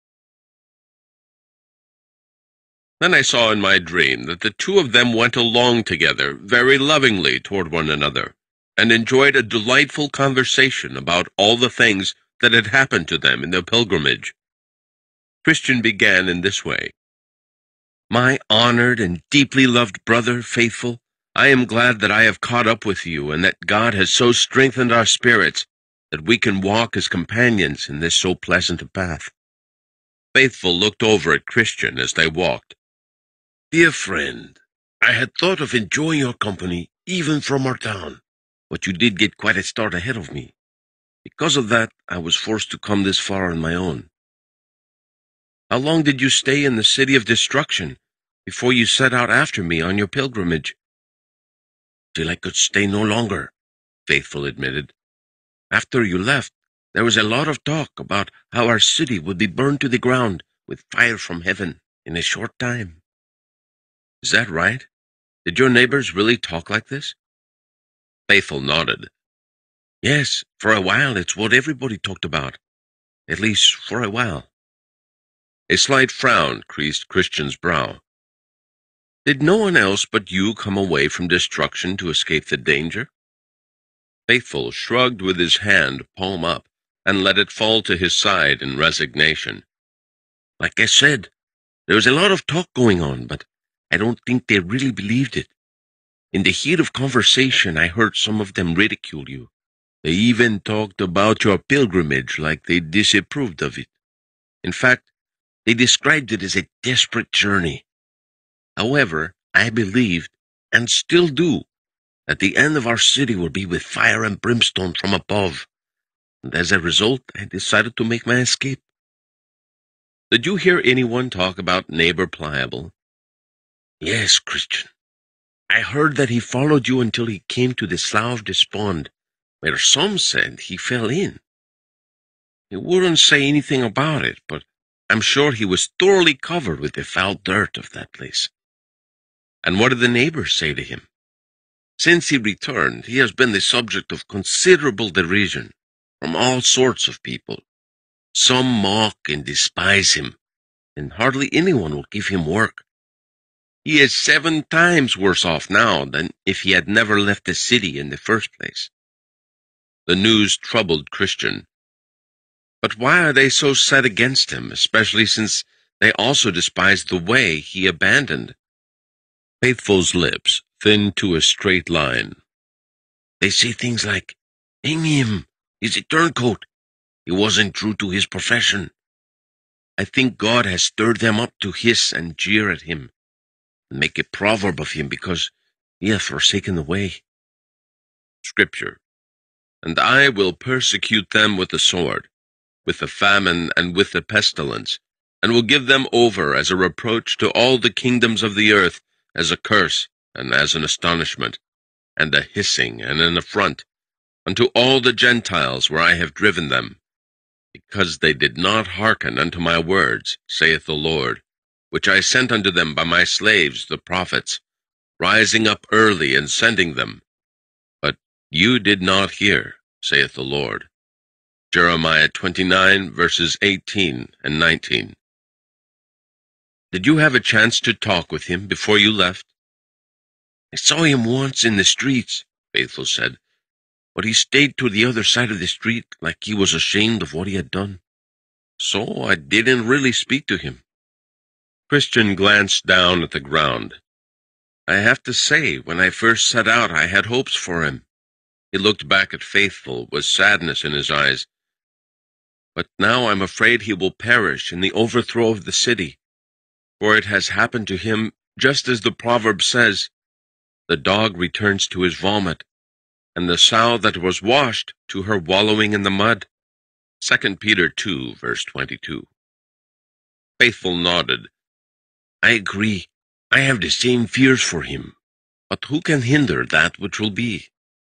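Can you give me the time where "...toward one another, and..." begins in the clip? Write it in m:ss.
0:07.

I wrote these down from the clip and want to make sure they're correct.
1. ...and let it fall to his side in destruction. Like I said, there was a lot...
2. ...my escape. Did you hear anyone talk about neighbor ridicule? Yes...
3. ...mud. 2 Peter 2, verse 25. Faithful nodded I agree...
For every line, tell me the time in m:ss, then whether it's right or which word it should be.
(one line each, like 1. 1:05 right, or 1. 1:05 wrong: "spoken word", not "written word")
1. 1:27 wrong: "resignation", not "destruction"
2. 1:58 wrong: "pliable", not "ridicule"
3. 4:26 wrong: "22", not "25".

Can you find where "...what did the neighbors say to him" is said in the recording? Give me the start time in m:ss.
2:19.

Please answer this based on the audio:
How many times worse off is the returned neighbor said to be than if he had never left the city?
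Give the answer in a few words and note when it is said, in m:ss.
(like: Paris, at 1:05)
7, at 2:34.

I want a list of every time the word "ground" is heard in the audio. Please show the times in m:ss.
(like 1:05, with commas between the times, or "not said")
0:59, 4:03.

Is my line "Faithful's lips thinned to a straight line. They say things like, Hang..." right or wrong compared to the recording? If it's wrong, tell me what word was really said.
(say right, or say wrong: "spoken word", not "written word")
right.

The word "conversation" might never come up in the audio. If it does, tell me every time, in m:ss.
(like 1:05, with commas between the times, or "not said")
0:10, 1:36.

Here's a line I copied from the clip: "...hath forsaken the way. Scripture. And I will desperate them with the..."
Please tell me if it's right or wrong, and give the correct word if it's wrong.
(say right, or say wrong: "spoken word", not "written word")
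wrong: "persecute", not "desperate".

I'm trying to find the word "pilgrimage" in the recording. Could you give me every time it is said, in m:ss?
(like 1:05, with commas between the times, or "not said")
0:13, 0:50, 1:41.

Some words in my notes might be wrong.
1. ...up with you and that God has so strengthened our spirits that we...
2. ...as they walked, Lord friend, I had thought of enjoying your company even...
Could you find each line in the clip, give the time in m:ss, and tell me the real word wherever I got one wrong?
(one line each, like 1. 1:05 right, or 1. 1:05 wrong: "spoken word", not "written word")
1. 0:22 right
2. 0:31 wrong: "Dear", not "Lord".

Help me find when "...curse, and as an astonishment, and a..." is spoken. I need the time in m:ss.
3:19.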